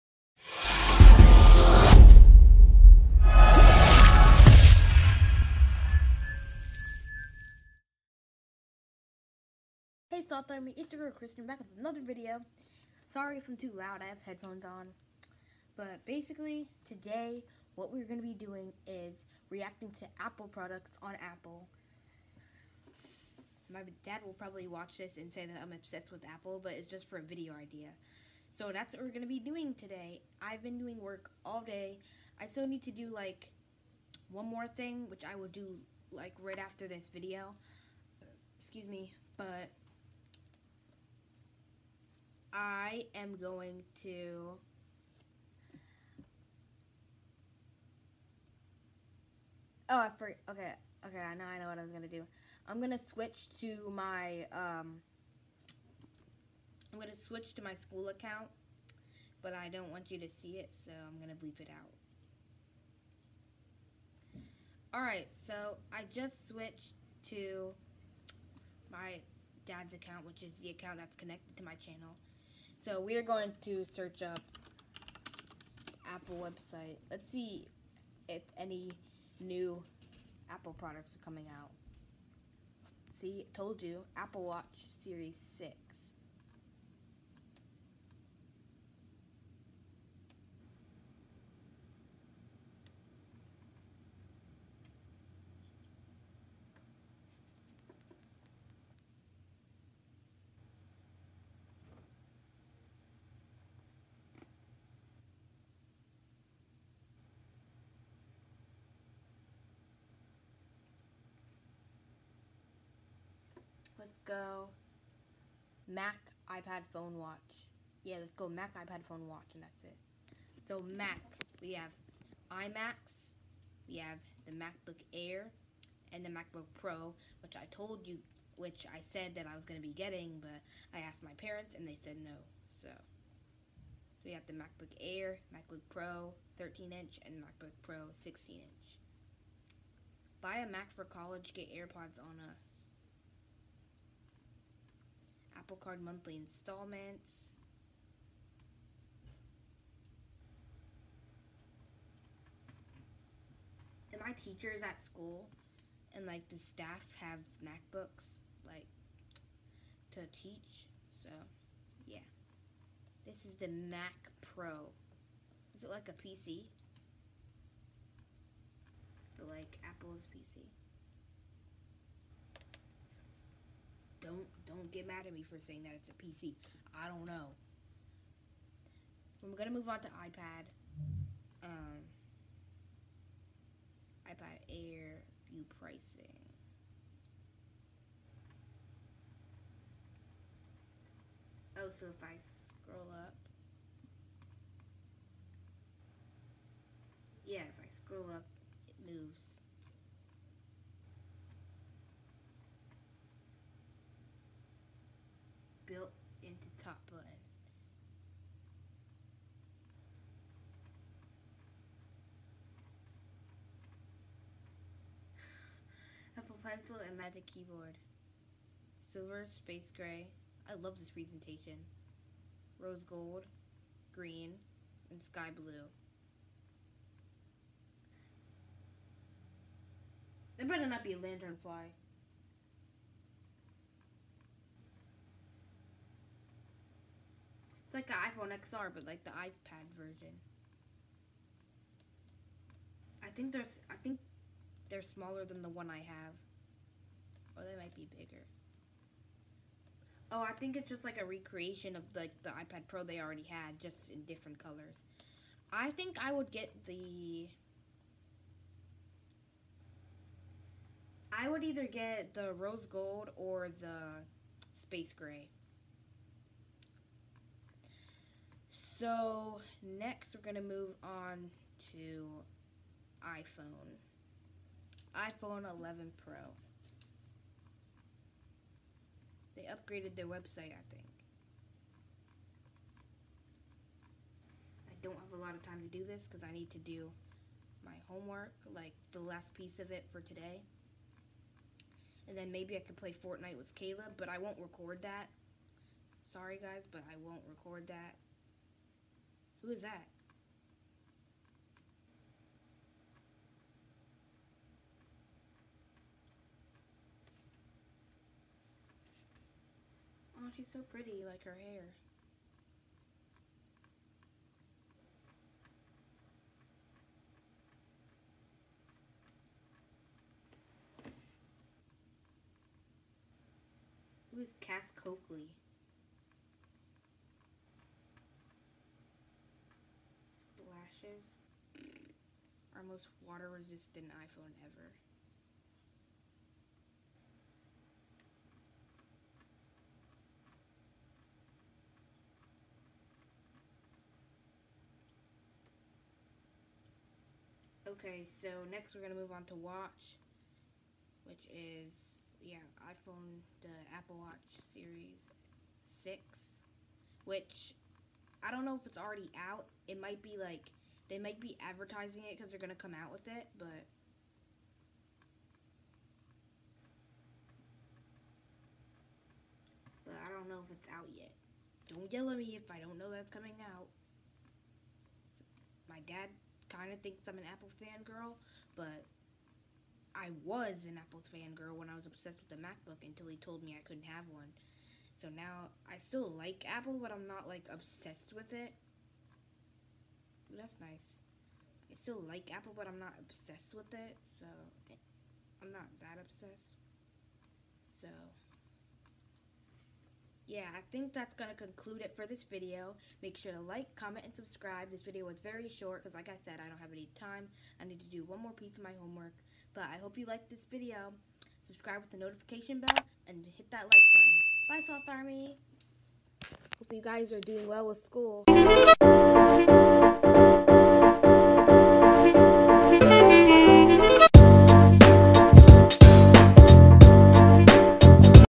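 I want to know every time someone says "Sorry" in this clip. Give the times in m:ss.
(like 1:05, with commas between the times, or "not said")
0:13, 4:56.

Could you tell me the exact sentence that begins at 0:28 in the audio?
So that's what we're going to be doing today.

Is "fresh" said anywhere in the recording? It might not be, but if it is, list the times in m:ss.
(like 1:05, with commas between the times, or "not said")
not said.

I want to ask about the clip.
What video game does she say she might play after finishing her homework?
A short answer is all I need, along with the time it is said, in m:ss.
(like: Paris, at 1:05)
Fortnite, at 4:53.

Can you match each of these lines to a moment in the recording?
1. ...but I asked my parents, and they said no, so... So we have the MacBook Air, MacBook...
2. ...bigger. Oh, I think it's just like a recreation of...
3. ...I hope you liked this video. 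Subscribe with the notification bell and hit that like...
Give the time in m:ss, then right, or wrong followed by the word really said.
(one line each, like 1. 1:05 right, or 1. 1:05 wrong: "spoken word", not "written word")
1. 2:10 right
2. 4:08 right
3. 6:49 right.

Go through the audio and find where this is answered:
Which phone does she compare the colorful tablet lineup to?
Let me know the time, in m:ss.
3:58.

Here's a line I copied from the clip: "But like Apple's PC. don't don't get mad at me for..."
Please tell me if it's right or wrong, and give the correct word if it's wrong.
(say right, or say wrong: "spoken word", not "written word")
right.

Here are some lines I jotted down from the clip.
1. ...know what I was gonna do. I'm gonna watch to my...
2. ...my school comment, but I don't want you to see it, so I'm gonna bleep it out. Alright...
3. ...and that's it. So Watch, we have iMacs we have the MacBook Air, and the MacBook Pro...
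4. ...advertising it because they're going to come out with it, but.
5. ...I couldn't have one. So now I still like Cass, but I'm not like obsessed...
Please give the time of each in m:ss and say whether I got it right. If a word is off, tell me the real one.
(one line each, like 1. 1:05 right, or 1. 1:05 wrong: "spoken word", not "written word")
1. 0:51 wrong: "switch", not "watch"
2. 0:57 wrong: "account", not "comment"
3. 1:59 wrong: "Mac", not "Watch"
4. 6:01 right
5. 6:23 wrong: "Apple", not "Cass".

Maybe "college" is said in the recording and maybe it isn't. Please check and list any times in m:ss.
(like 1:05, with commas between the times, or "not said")
2:21.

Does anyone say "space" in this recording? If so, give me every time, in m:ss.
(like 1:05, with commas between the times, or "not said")
3:39, 4:24.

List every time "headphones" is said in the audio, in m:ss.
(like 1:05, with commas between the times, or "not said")
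0:14.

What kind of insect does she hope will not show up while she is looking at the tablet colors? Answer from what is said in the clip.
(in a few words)
lantern fly.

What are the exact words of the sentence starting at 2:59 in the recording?
We're gonna move on to iPad.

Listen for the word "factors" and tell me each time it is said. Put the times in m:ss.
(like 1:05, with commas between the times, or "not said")
not said.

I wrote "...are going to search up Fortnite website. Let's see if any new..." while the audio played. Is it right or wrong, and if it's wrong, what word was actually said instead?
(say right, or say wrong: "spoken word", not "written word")
wrong: "Apple", not "Fortnite".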